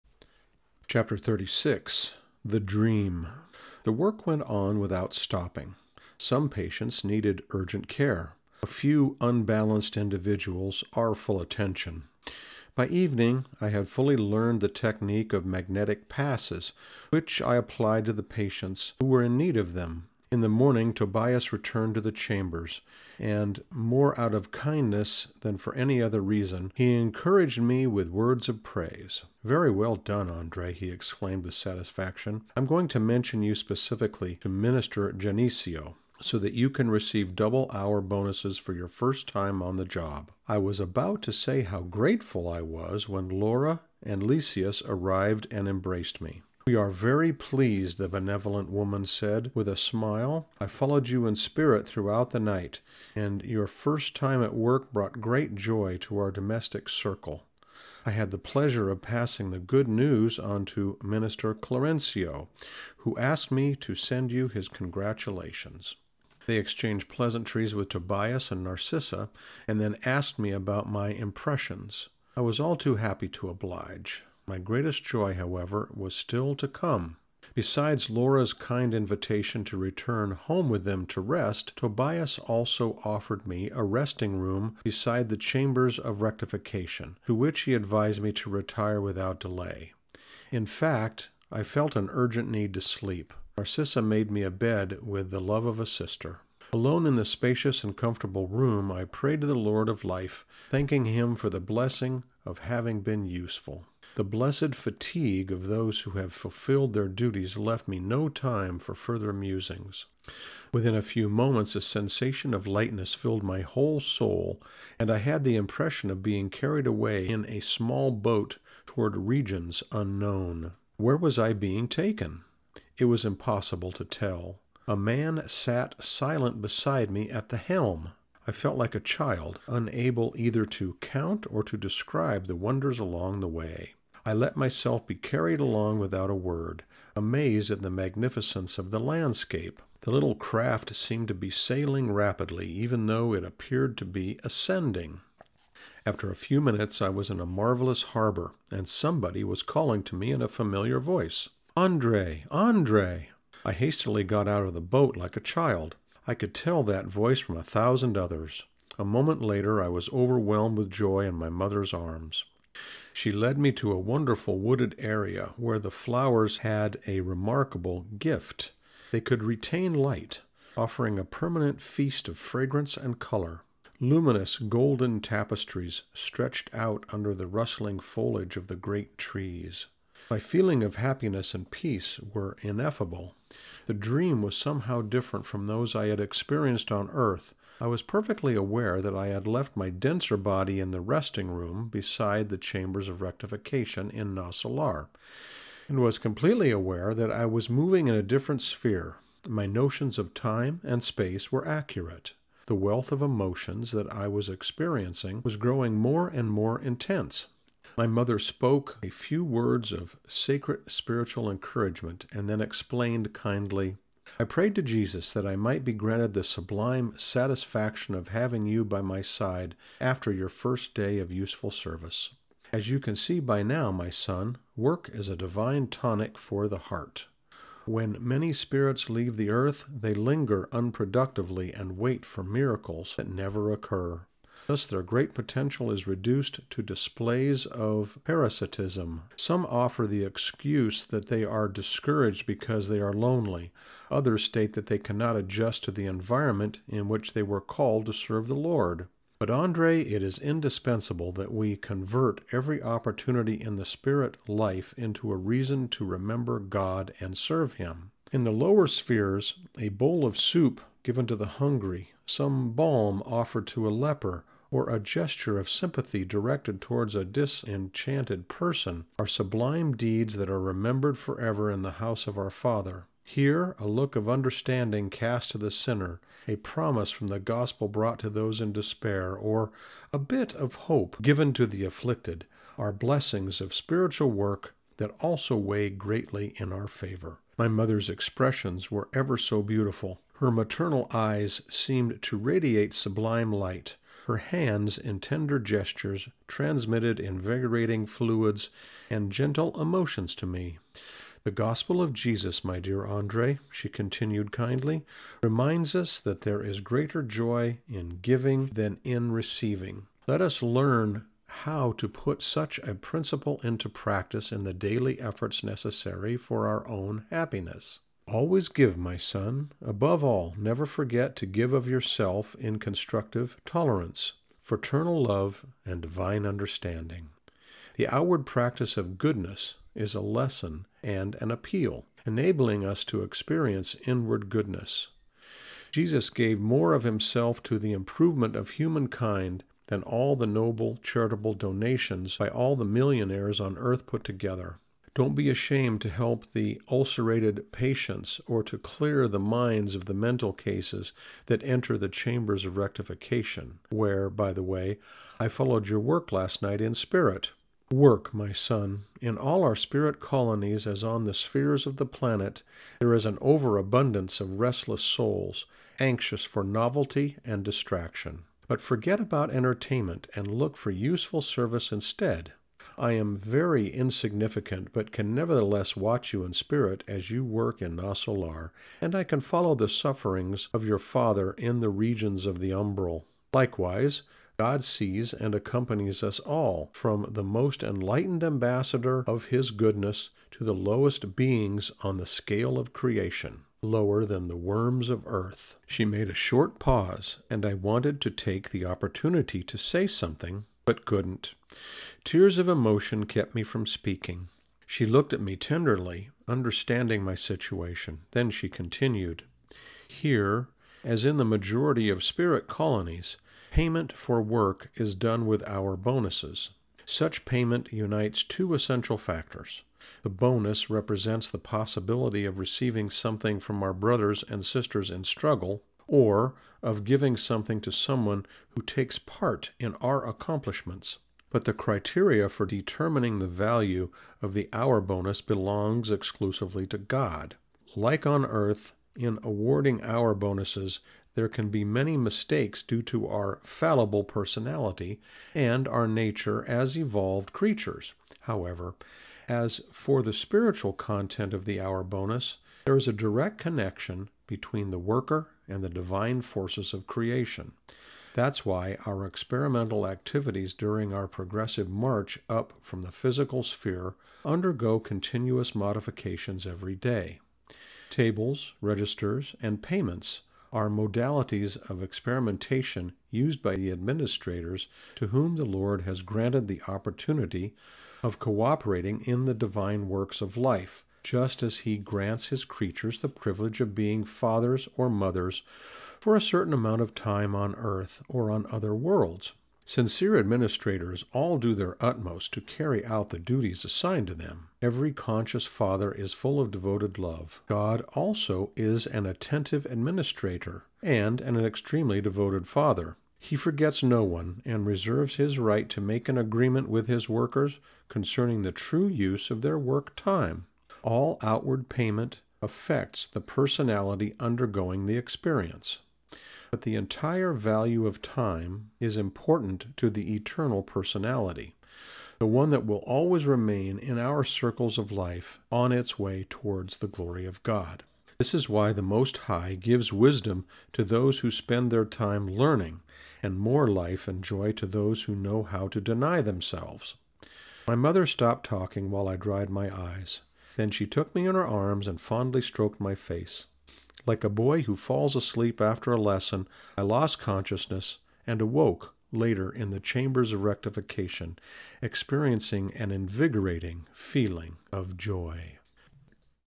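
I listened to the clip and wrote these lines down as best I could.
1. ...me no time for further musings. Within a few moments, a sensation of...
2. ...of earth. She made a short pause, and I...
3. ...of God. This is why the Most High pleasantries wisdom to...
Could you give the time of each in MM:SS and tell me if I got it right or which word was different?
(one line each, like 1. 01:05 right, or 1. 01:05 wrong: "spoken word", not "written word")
1. 01:47 right
2. 06:35 right
3. 08:47 wrong: "gives", not "pleasantries".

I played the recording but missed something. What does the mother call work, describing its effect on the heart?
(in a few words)
a divine tonic.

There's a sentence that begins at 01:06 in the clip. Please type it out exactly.
They exchanged pleasantries with Tobias and Narcissa, and then asked me about my impressions.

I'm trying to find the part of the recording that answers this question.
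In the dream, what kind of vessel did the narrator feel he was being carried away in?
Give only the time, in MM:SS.
01:57.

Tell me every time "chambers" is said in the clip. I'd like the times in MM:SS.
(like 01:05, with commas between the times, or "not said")
00:22, 01:25, 03:12, 05:52, 09:09.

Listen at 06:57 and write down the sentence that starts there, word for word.
Such payment unites two essential factors.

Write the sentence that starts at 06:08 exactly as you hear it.
But forget about entertainment and look for useful service instead.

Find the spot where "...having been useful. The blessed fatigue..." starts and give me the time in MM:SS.
01:42.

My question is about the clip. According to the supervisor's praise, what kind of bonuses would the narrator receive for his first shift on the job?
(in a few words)
double hour bonuses.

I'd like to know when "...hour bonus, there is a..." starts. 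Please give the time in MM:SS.
07:31.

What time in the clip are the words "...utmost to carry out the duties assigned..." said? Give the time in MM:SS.
08:11.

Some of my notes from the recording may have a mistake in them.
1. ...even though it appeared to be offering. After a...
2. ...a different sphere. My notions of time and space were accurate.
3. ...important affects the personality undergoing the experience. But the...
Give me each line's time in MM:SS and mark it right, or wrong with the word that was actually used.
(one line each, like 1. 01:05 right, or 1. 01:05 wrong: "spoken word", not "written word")
1. 02:22 wrong: "ascending", not "offering"
2. 03:18 right
3. 08:31 wrong: "payment", not "important".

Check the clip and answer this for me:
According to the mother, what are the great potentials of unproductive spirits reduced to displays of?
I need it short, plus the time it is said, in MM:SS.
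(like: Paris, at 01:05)
parasitism, at 03:58.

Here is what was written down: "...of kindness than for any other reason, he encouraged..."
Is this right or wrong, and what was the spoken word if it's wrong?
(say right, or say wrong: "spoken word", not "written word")
right.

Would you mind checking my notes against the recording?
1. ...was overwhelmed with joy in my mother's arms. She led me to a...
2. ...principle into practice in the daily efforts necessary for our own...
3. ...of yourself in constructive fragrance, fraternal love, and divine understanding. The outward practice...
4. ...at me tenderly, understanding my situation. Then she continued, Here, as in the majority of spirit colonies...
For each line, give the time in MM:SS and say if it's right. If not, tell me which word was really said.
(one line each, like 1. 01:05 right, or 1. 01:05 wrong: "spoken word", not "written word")
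1. 02:39 right
2. 05:12 right
3. 05:21 wrong: "tolerance", not "fragrance"
4. 06:45 right.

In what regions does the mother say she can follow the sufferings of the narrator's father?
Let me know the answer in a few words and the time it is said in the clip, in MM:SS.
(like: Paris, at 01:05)
the umbral, at 06:22.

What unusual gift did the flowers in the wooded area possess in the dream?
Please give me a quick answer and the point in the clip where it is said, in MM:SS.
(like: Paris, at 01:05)
retain light, at 02:49.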